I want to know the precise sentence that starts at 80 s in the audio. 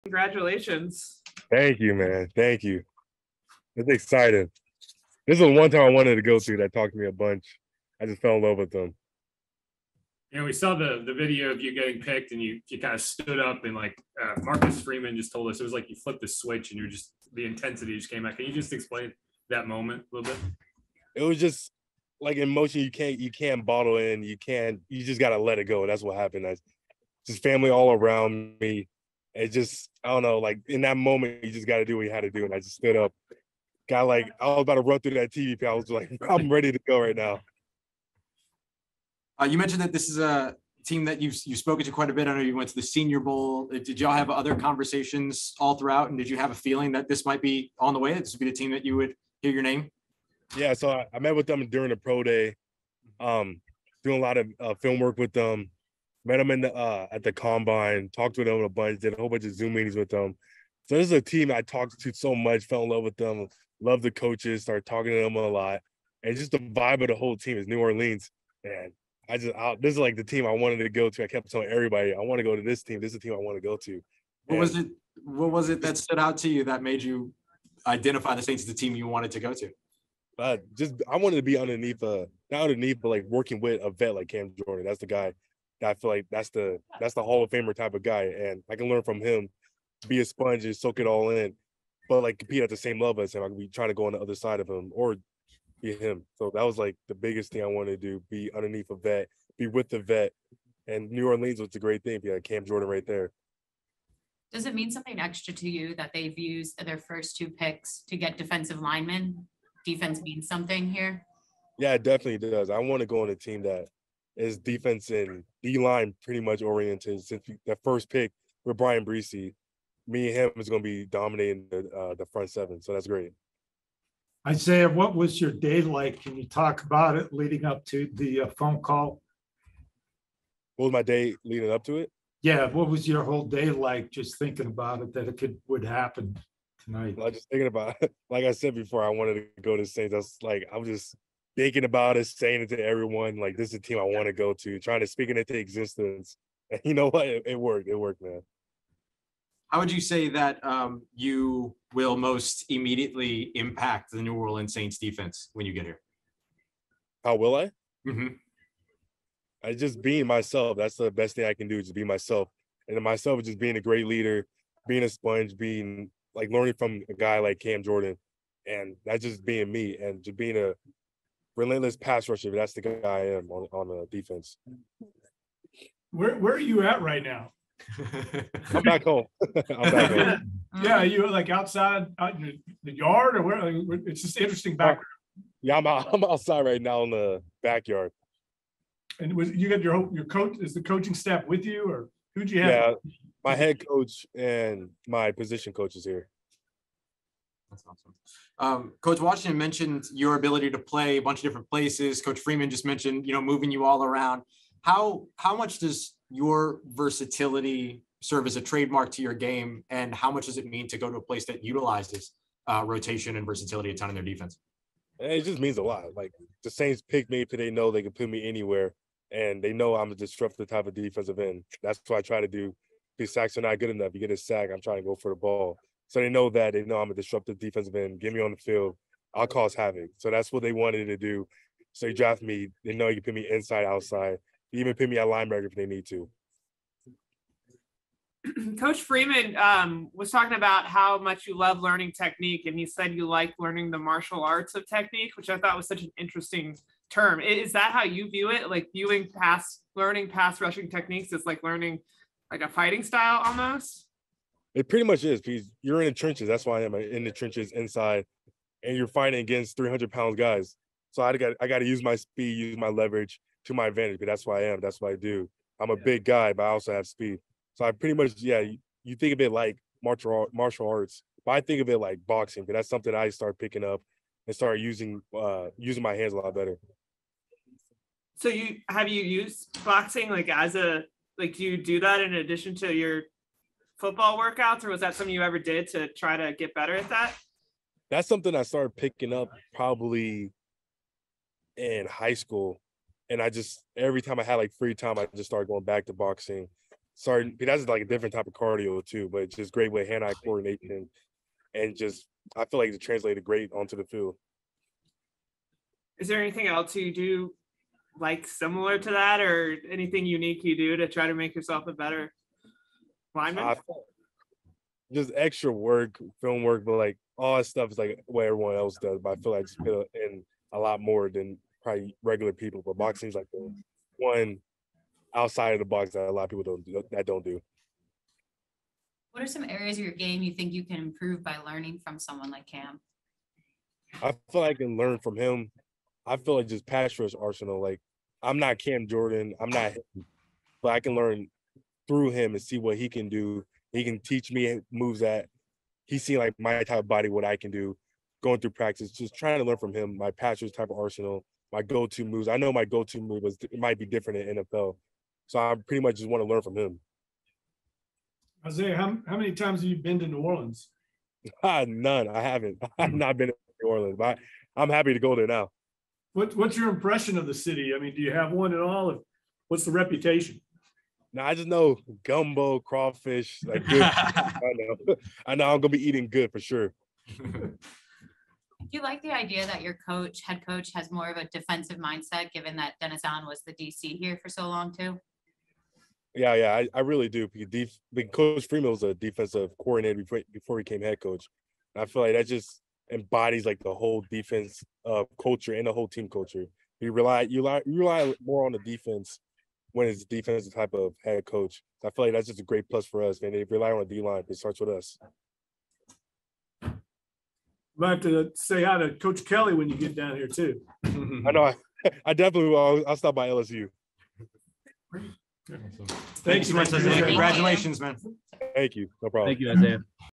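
Uh, just I wanted to be underneath uh not underneath, but like working with a vet like Cam Jordan.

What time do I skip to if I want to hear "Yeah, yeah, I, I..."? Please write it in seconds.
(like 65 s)
386 s.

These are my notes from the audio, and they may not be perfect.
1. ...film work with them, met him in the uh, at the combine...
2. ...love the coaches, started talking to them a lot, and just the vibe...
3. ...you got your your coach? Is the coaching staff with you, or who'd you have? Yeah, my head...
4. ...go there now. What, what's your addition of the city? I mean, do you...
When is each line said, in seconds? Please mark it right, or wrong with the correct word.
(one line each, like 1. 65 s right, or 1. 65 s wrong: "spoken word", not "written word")
1. 54 s right
2. 63 s right
3. 189 s right
4. 365 s wrong: "impression", not "addition".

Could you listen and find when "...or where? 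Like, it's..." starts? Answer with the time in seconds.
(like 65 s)
183 s.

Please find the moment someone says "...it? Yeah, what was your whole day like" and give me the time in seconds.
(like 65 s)
131 s.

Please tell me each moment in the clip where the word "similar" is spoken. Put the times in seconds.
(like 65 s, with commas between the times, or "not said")
308 s.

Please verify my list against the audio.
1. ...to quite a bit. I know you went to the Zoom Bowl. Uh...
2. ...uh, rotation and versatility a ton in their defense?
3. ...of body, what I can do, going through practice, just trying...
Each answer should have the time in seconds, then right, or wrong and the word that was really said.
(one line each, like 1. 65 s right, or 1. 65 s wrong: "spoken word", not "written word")
1. 41 s wrong: "Senior", not "Zoom"
2. 212 s right
3. 346 s right.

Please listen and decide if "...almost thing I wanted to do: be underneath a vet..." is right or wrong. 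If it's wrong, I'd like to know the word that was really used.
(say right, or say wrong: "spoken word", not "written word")
wrong: "biggest", not "almost".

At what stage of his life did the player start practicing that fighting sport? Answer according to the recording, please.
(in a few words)
High school.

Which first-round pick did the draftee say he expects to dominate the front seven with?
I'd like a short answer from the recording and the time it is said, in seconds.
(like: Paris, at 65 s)
Bryan Bresee, at 118 s.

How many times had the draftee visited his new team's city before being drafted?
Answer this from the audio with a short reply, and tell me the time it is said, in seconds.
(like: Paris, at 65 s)
0, at 361 s.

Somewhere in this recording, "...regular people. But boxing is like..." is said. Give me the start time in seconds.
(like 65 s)
322 s.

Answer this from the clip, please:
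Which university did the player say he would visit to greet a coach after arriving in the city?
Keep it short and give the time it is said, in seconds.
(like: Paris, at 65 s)
LSU, at 413 s.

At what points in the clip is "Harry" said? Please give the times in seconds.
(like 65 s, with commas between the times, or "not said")
not said.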